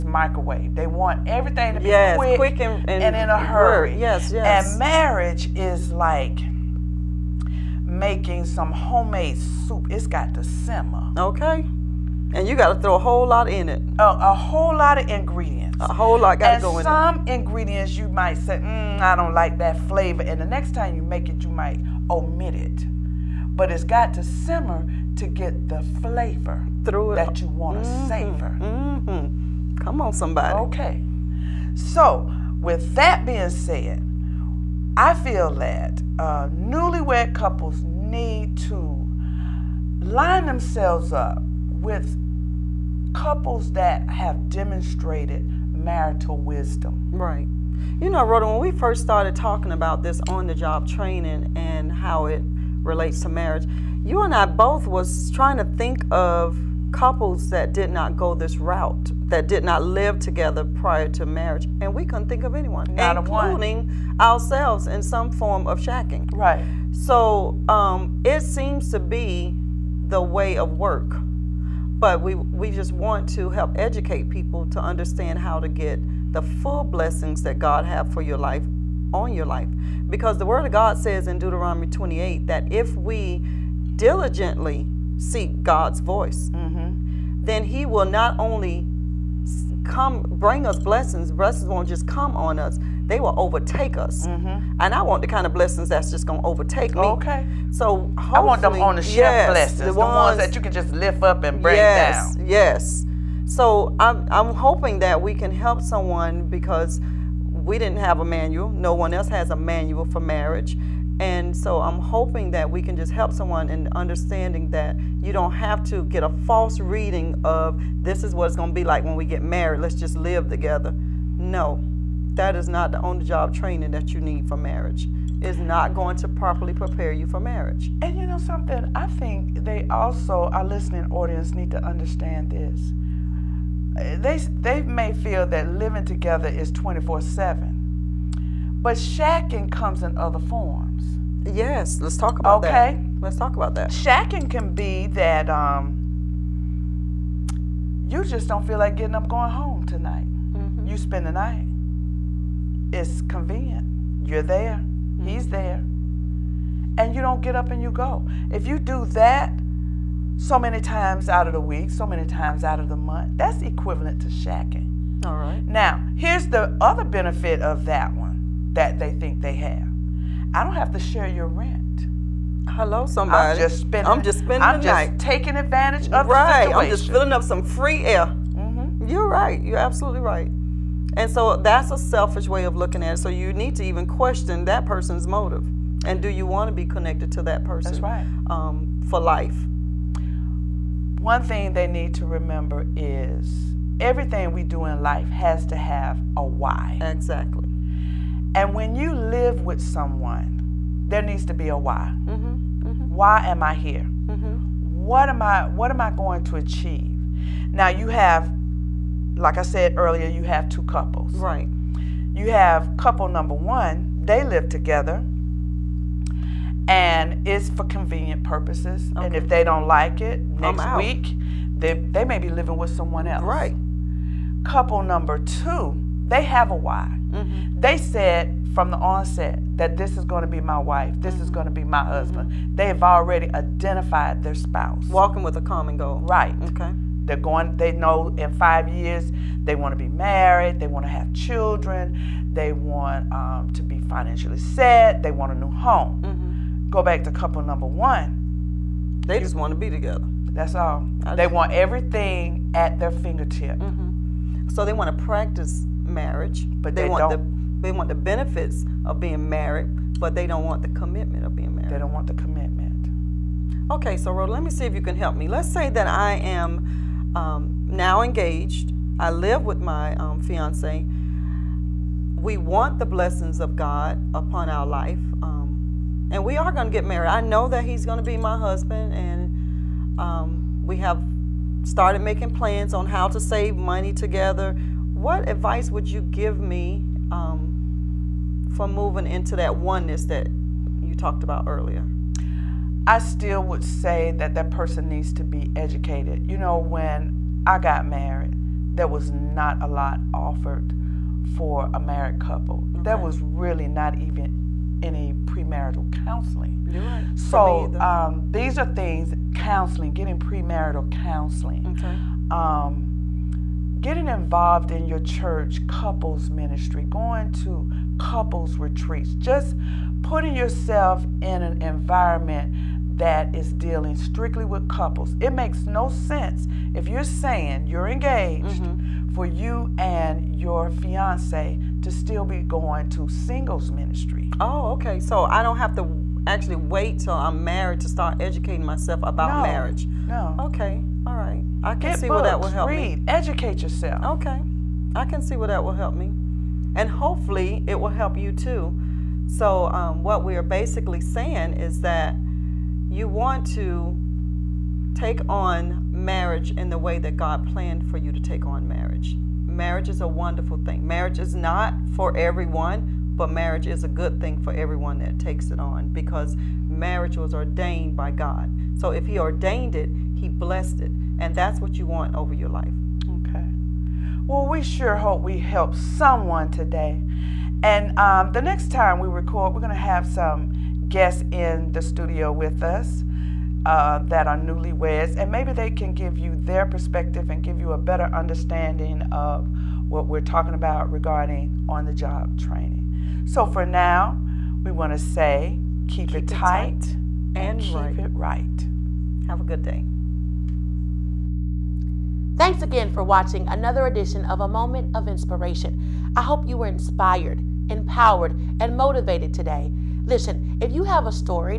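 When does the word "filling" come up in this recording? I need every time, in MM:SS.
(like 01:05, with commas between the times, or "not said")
02:57.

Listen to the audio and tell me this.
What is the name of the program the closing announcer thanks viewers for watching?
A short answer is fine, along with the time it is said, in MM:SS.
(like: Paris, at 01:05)
A Moment of Inspiration, at 06:44.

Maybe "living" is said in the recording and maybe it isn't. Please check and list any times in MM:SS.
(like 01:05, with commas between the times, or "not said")
02:15, 03:42.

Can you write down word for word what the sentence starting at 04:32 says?
We want the blessings of God upon our life.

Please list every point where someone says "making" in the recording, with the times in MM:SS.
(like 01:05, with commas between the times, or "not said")
00:07, 04:42.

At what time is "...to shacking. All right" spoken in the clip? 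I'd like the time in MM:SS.
02:44.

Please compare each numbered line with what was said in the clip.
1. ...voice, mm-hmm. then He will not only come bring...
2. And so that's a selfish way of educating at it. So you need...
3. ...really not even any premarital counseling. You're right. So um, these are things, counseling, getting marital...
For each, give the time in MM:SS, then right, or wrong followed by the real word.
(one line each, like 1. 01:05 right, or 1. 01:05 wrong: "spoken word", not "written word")
1. 01:26 right
2. 03:01 wrong: "looking", not "educating"
3. 05:03 wrong: "premarital", not "marital".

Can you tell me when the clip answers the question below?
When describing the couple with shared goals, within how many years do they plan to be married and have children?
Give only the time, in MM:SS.
03:58.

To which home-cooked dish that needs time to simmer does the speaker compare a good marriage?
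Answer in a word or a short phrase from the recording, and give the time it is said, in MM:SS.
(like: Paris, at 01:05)
homemade soup, at 00:08.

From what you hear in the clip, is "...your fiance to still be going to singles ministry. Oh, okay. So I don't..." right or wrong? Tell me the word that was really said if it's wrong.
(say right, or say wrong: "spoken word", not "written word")
right.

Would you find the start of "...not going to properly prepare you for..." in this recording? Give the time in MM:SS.
02:05.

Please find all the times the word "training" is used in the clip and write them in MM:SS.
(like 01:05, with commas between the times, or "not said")
00:50, 02:03, 06:32.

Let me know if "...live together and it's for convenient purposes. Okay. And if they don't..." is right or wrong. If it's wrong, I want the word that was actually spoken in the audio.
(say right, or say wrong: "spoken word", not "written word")
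right.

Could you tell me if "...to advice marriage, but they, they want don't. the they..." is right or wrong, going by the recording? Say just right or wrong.
wrong.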